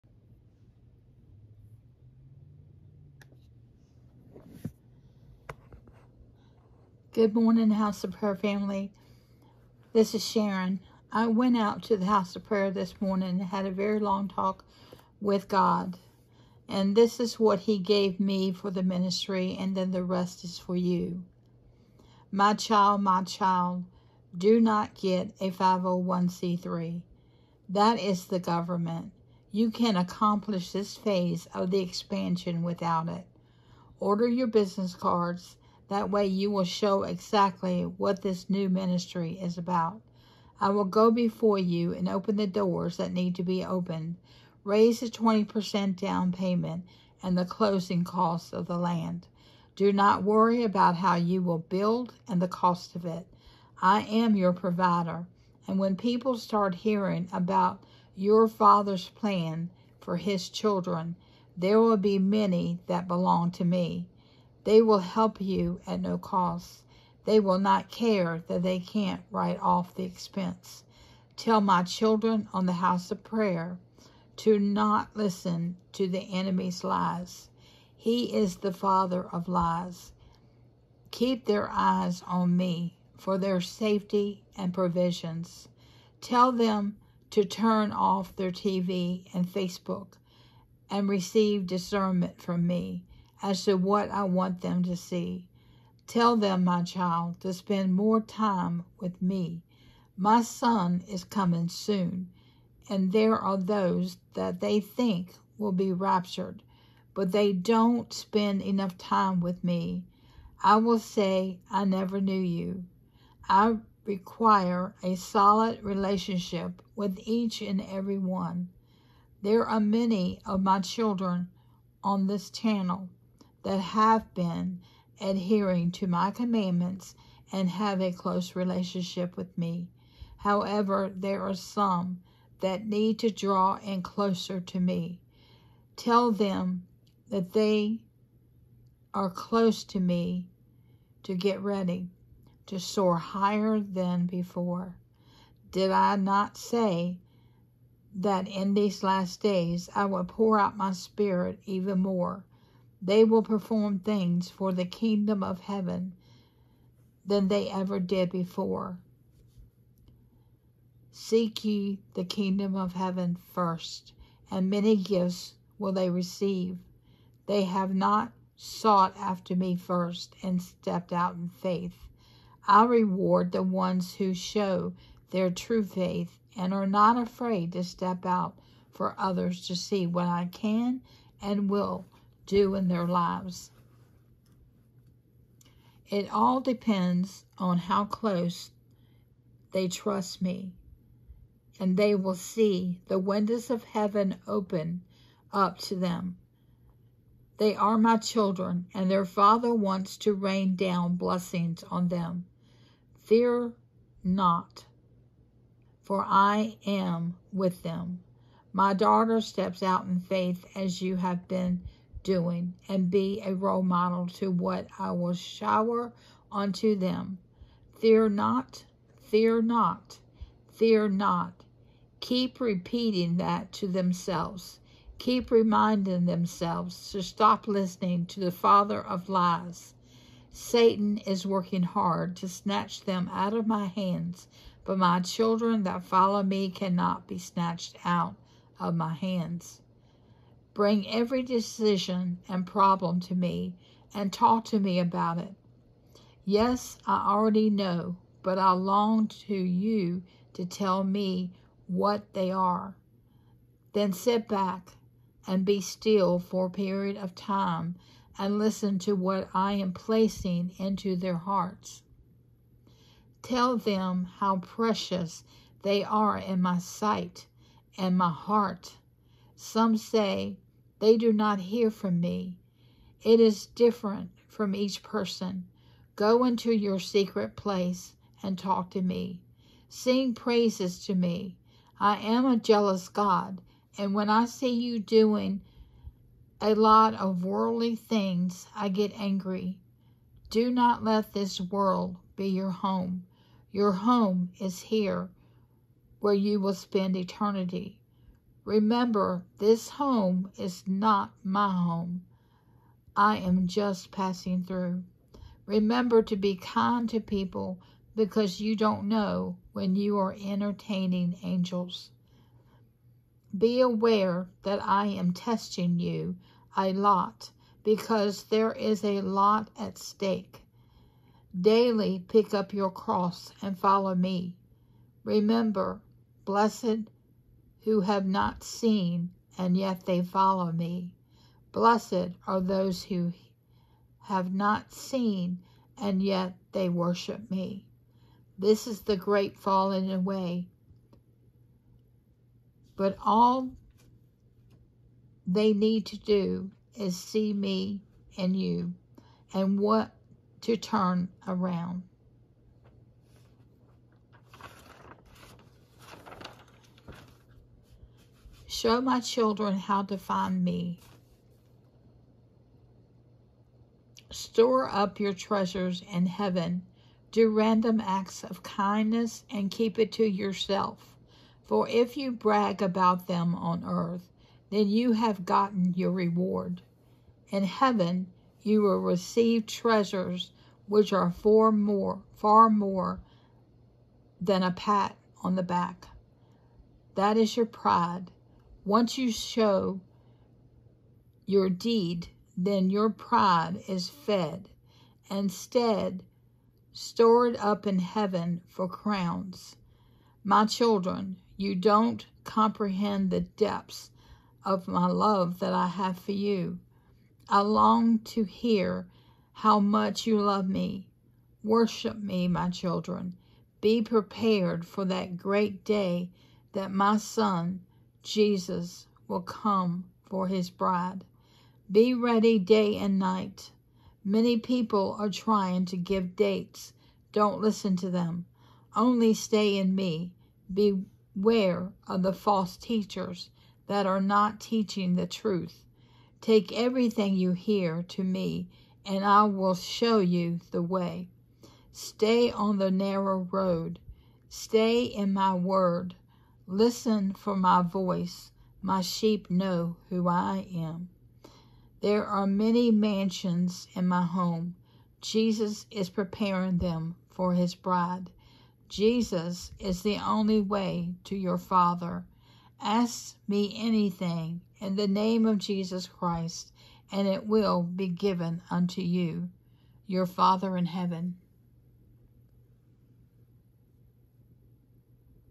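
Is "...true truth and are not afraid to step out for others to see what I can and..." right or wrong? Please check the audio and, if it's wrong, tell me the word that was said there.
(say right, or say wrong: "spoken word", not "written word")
wrong: "faith", not "truth".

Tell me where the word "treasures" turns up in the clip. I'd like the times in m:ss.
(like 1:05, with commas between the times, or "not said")
6:05, 6:19.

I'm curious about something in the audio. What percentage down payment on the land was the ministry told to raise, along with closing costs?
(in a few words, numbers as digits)
20%.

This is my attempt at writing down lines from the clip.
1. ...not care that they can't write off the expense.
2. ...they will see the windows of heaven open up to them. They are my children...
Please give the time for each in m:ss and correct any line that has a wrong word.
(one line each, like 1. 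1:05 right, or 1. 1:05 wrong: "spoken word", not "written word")
1. 1:07 right
2. 3:11 right.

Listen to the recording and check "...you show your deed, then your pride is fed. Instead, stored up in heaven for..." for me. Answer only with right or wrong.
right.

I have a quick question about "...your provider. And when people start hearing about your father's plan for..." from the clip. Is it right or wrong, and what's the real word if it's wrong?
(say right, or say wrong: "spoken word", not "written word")
right.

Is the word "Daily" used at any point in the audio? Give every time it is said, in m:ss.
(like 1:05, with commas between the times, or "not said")
5:21.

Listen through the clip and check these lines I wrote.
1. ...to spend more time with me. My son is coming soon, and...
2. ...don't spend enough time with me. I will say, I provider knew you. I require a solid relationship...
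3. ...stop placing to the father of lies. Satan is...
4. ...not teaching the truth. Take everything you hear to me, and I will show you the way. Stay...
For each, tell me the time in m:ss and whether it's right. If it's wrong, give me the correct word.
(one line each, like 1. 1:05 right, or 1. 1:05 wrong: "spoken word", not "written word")
1. 1:37 right
2. 1:47 wrong: "never", not "provider"
3. 3:47 wrong: "listening", not "placing"
4. 7:14 right.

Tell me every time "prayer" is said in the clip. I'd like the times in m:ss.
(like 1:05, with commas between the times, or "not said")
0:08, 0:12, 1:13.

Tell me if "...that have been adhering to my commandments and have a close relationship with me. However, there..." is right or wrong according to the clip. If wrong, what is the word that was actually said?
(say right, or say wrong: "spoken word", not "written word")
right.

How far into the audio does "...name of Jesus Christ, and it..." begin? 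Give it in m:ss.
7:45.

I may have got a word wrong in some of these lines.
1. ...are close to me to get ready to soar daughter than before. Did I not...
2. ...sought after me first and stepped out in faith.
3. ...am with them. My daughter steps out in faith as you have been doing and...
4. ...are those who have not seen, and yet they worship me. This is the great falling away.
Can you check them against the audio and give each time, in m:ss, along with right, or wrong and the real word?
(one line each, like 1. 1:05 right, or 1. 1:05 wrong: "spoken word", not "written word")
1. 2:19 wrong: "higher", not "daughter"
2. 2:48 right
3. 3:26 right
4. 5:32 right.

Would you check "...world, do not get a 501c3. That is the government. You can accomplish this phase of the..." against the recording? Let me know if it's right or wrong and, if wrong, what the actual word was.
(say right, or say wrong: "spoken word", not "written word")
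wrong: "child", not "world".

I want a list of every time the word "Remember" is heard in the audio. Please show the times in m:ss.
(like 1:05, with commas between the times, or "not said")
4:58, 5:05, 5:25.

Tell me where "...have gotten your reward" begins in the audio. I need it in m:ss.
6:15.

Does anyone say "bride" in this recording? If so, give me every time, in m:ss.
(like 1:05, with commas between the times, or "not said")
7:00, 7:37.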